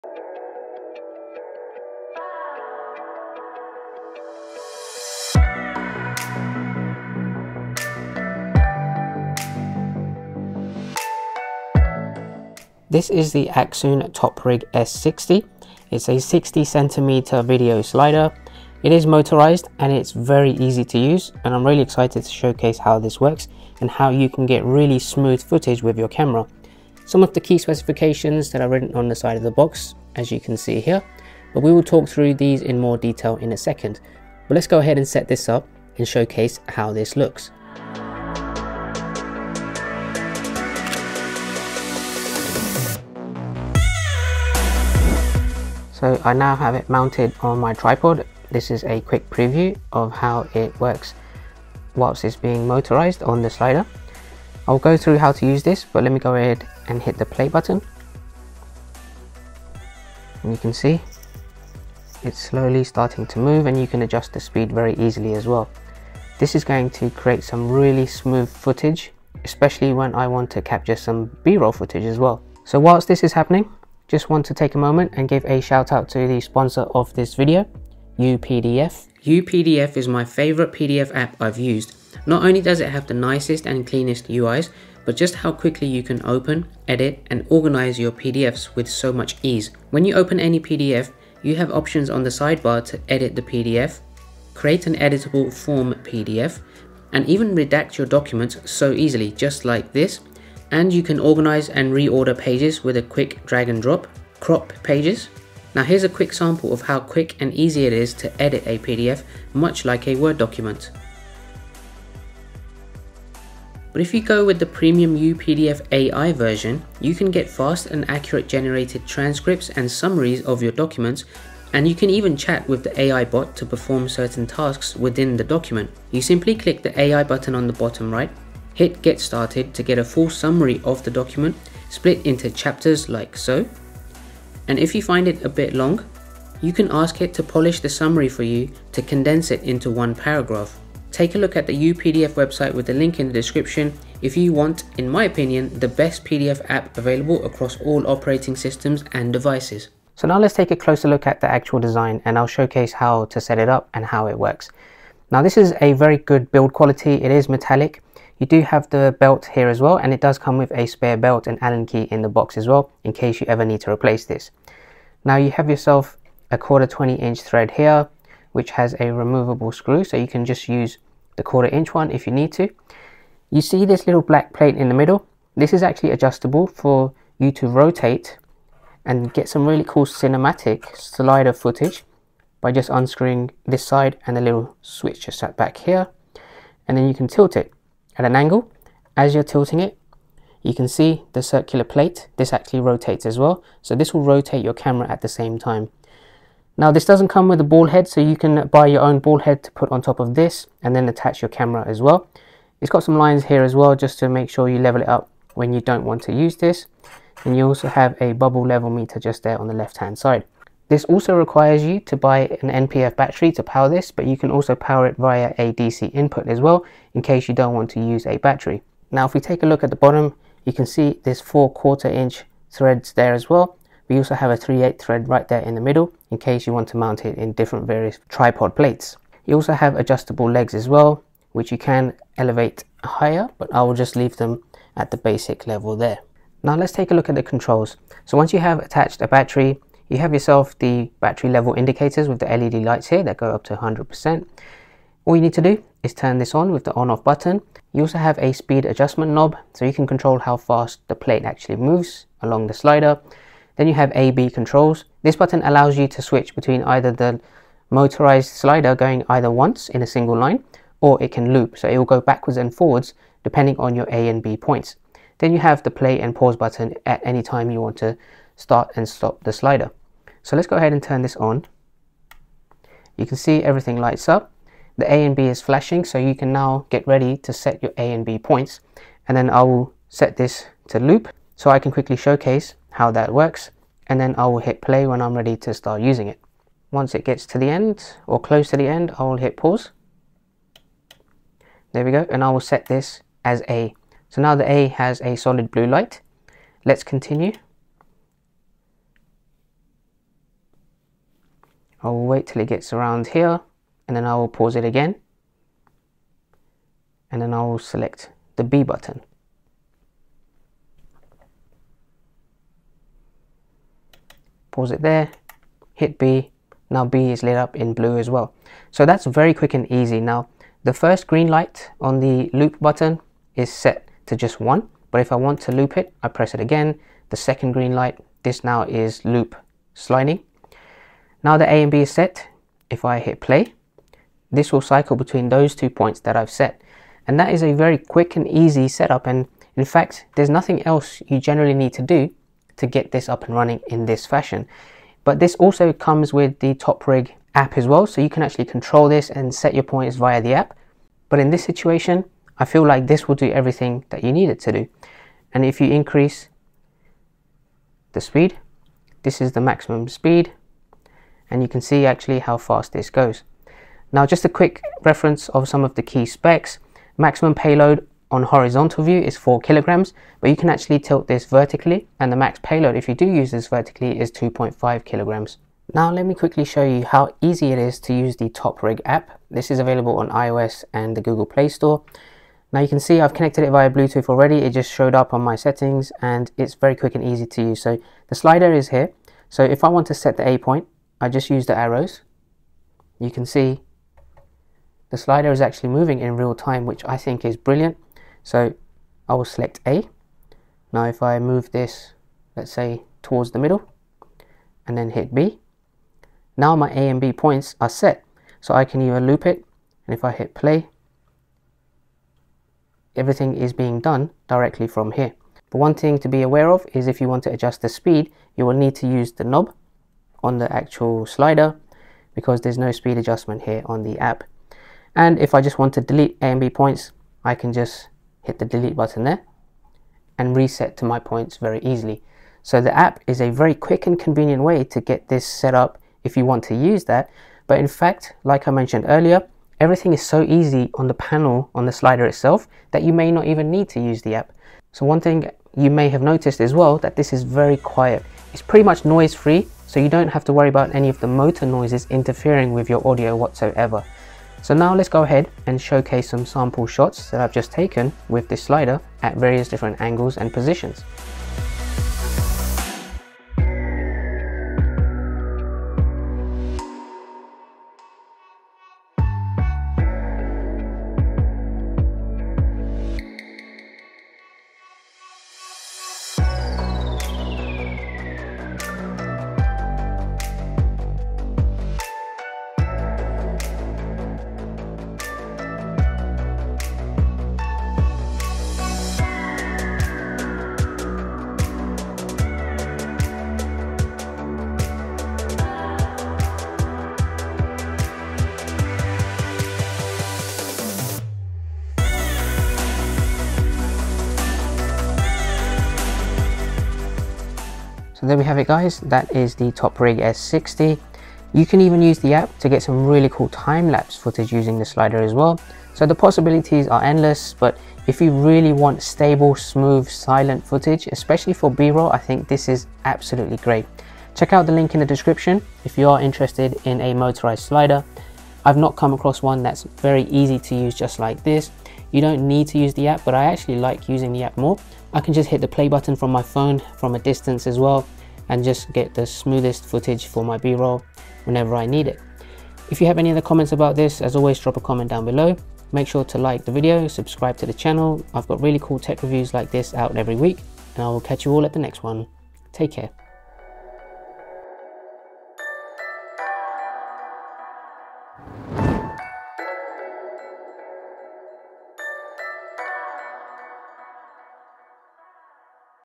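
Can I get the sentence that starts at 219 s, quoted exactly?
Now, if we take a look at the bottom, you can see there's four quarter inch threads there as well.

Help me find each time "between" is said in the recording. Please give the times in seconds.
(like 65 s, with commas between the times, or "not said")
256 s, 335 s.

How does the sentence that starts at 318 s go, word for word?
So that's very quick and easy.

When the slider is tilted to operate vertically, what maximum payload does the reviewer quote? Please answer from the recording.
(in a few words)
2.5 kg.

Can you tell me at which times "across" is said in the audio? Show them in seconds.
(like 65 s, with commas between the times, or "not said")
147 s, 529 s.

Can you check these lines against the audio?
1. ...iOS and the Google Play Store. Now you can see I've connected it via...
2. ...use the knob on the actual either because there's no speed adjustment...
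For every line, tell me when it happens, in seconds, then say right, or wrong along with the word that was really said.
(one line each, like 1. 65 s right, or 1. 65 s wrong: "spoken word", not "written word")
1. 380 s right
2. 419 s wrong: "slider", not "either".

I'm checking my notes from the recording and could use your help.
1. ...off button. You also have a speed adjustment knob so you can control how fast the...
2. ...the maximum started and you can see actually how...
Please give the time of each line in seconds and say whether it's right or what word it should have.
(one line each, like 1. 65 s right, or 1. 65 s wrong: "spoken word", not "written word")
1. 247 s right
2. 359 s wrong: "speed", not "started".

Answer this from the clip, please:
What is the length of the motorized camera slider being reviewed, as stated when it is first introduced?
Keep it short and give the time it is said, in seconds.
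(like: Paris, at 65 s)
60 cm, at 16 s.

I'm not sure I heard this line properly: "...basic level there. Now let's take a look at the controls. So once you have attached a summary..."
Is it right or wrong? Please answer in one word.
wrong.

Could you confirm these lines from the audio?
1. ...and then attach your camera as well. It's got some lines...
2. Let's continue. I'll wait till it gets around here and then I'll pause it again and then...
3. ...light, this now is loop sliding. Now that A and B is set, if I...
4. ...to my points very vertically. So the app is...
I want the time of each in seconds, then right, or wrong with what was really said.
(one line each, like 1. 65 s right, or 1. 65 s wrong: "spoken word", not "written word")
1. 200 s right
2. 296 s right
3. 327 s right
4. 430 s wrong: "easily", not "vertically".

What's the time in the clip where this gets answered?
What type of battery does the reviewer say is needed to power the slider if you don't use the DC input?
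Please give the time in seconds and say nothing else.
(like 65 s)
212 s.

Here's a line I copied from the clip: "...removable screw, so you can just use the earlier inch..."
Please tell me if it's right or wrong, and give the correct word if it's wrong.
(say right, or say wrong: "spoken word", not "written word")
wrong: "quarter", not "earlier".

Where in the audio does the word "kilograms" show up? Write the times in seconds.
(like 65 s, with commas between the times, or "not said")
369 s, 375 s.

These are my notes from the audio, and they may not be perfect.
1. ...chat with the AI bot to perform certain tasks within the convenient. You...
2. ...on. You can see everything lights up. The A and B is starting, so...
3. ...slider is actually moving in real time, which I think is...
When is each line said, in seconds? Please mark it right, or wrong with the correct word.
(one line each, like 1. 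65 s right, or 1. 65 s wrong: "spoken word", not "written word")
1. 122 s wrong: "document", not "convenient"
2. 271 s wrong: "flashing", not "starting"
3. 395 s right.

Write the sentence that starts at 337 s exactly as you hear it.
And that is a very quick and easy setup.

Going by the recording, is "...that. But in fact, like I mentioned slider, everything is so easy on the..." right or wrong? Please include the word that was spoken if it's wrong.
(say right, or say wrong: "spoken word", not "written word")
wrong: "earlier", not "slider".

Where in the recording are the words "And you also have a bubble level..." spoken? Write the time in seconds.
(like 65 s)
207 s.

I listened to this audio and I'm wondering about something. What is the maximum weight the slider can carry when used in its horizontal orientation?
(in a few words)
4 kg.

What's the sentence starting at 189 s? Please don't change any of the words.
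As you're tilting it, you can see the circular plate.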